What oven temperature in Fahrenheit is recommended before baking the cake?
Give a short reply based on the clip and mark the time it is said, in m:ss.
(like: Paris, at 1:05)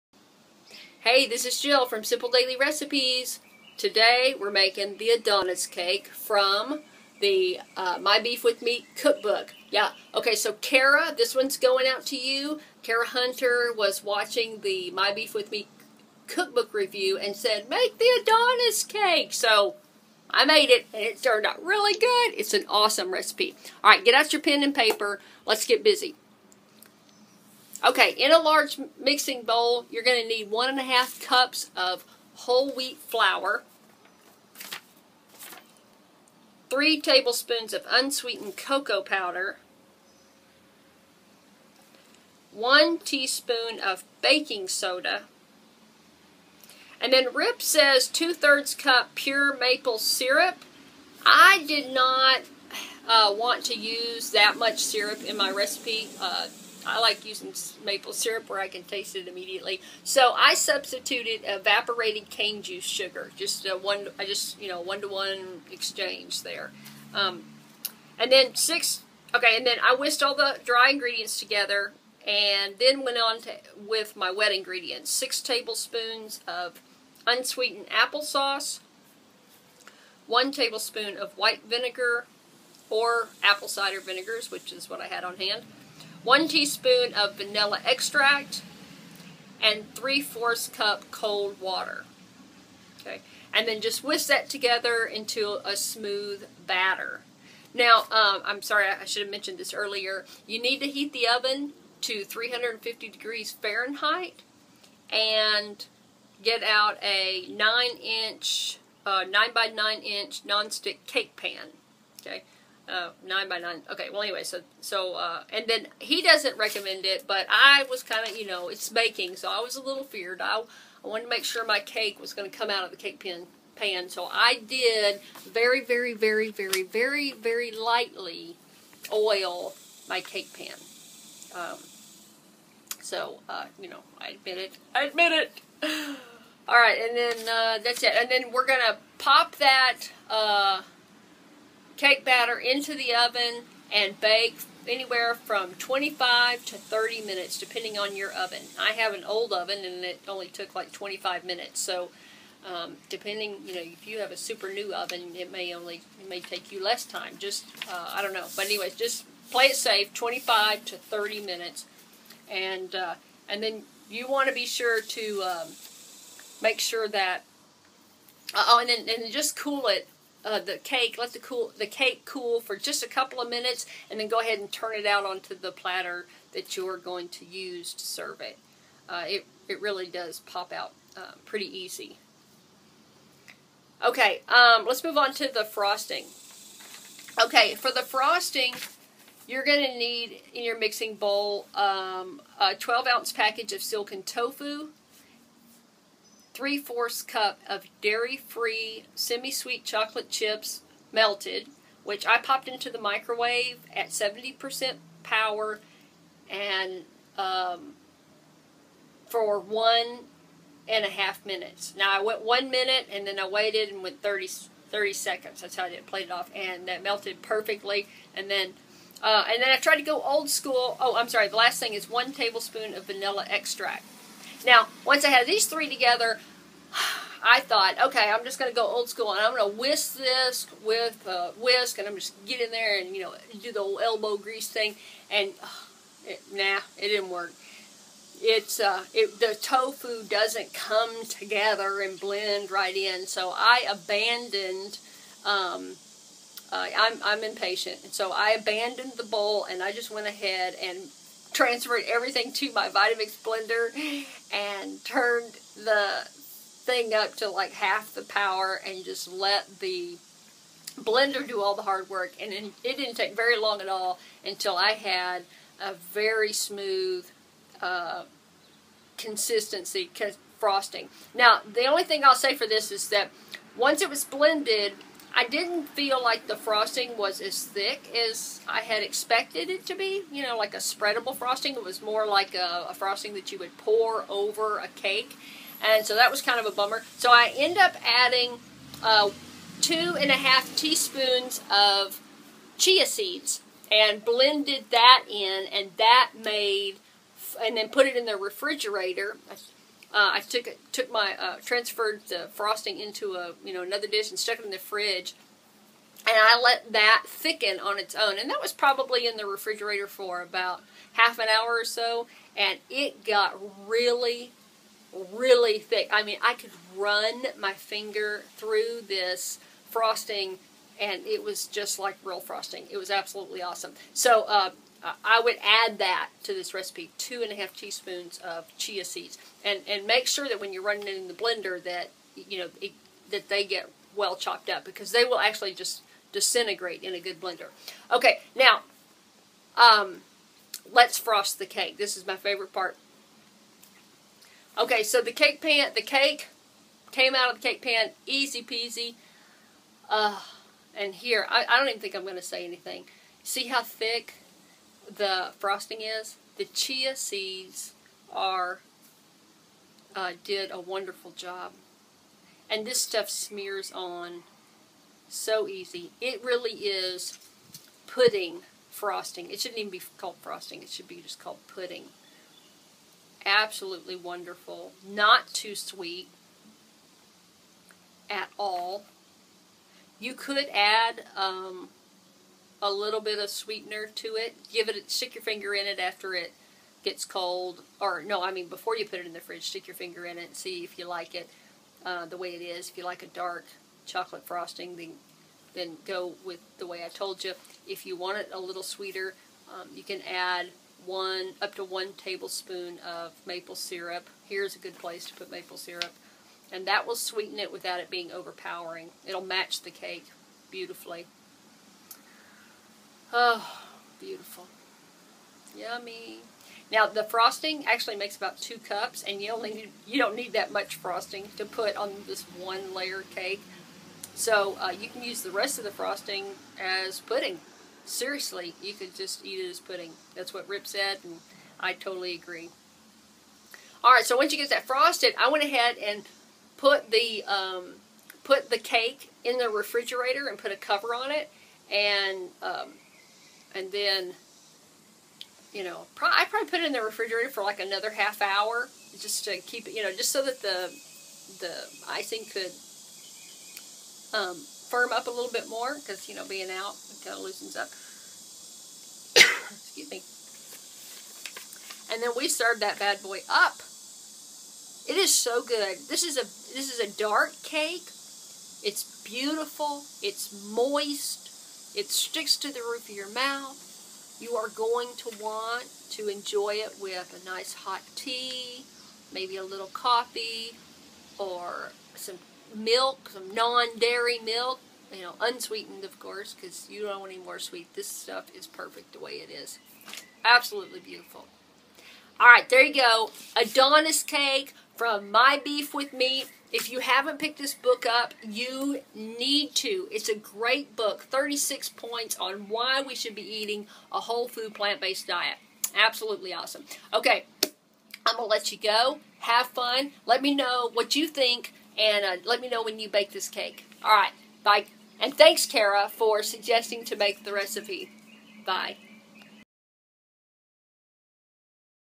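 350 degrees, at 1:42.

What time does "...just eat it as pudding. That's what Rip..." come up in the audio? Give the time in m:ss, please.
7:09.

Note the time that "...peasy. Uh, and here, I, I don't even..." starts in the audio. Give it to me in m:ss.
5:48.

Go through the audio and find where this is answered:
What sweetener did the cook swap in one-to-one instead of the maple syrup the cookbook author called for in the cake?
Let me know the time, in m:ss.
1:01.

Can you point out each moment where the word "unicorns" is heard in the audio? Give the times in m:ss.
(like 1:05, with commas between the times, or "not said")
not said.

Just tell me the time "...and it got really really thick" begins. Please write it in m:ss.
5:12.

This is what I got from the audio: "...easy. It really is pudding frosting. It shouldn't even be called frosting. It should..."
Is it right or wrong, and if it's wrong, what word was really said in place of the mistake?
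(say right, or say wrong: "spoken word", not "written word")
right.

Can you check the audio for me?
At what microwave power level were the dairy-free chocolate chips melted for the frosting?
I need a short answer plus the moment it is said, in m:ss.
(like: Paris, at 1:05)
70%, at 3:24.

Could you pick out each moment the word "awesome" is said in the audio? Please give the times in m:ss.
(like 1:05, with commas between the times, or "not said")
0:22, 5:23, 8:26.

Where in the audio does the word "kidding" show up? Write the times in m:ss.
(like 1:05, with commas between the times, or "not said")
not said.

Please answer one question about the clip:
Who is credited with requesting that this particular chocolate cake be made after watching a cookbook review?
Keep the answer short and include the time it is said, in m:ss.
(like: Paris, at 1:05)
Cara Hunter, at 0:12.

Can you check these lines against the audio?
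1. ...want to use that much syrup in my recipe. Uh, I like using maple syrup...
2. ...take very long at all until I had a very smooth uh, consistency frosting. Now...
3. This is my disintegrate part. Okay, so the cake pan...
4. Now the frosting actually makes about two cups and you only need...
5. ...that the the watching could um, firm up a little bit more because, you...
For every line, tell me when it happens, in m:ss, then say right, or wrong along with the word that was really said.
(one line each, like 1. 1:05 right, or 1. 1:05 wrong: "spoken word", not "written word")
1. 0:53 right
2. 4:23 right
3. 5:41 wrong: "favorite", not "disintegrate"
4. 6:56 right
5. 7:30 wrong: "icing", not "watching".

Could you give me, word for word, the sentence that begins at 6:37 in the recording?
If you want it a little sweeter, um, you can add one up to one tablespoon of maple syrup.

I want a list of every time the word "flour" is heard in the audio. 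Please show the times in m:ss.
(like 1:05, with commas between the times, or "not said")
0:32.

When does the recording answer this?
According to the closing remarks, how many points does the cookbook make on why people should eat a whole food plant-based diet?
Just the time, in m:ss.
8:21.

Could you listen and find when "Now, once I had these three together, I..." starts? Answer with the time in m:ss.
3:44.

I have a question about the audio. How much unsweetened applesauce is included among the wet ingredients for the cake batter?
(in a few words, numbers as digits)
6 tablespoons.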